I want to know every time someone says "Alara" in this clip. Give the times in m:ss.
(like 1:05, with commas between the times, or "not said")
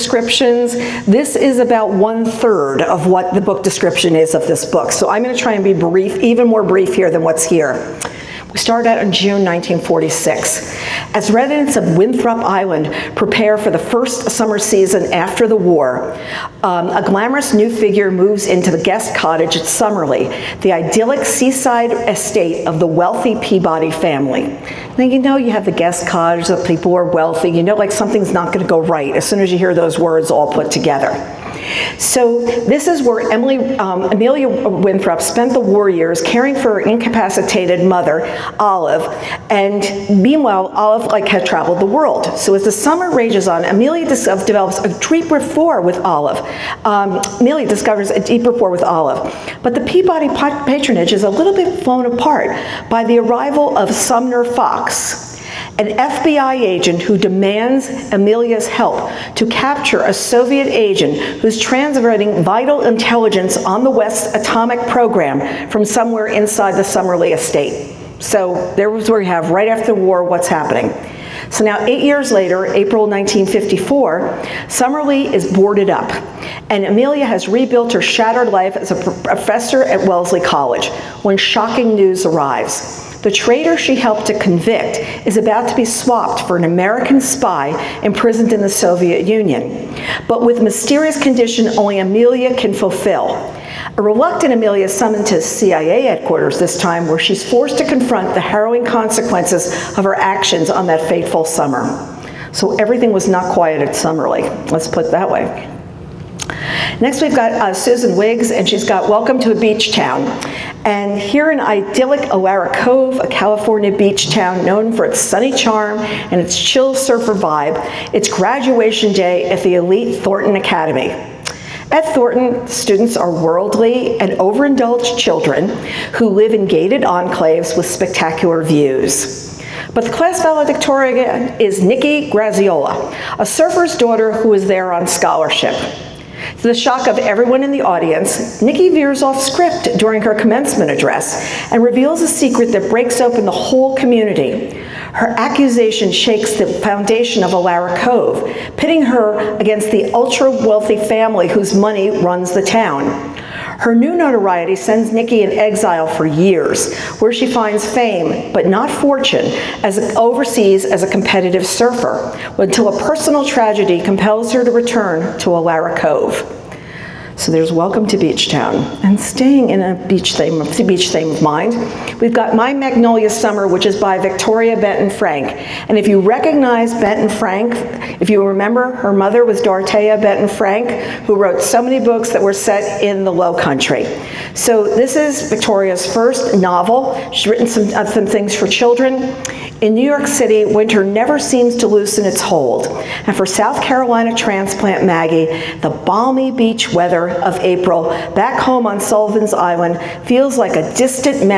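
2:27, 2:45.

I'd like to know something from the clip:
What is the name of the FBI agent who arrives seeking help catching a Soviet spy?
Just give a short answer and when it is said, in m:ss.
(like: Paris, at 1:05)
Sumner Fox, at 0:53.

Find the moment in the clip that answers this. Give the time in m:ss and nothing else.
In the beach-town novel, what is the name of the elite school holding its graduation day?
2:00.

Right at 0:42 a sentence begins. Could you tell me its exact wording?
So as the summer rages on, Amelia uh, develops a deep rapport with Olive.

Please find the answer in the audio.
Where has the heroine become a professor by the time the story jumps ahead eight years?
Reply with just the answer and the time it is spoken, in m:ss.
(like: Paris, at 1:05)
Wellesley College, at 1:20.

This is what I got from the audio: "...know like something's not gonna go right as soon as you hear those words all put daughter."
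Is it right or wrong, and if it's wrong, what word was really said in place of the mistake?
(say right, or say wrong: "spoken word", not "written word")
wrong: "together", not "daughter".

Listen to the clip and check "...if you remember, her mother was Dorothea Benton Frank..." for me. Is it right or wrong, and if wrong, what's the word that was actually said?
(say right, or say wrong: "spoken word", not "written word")
right.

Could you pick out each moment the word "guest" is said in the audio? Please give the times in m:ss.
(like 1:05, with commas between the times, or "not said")
0:18, 0:25.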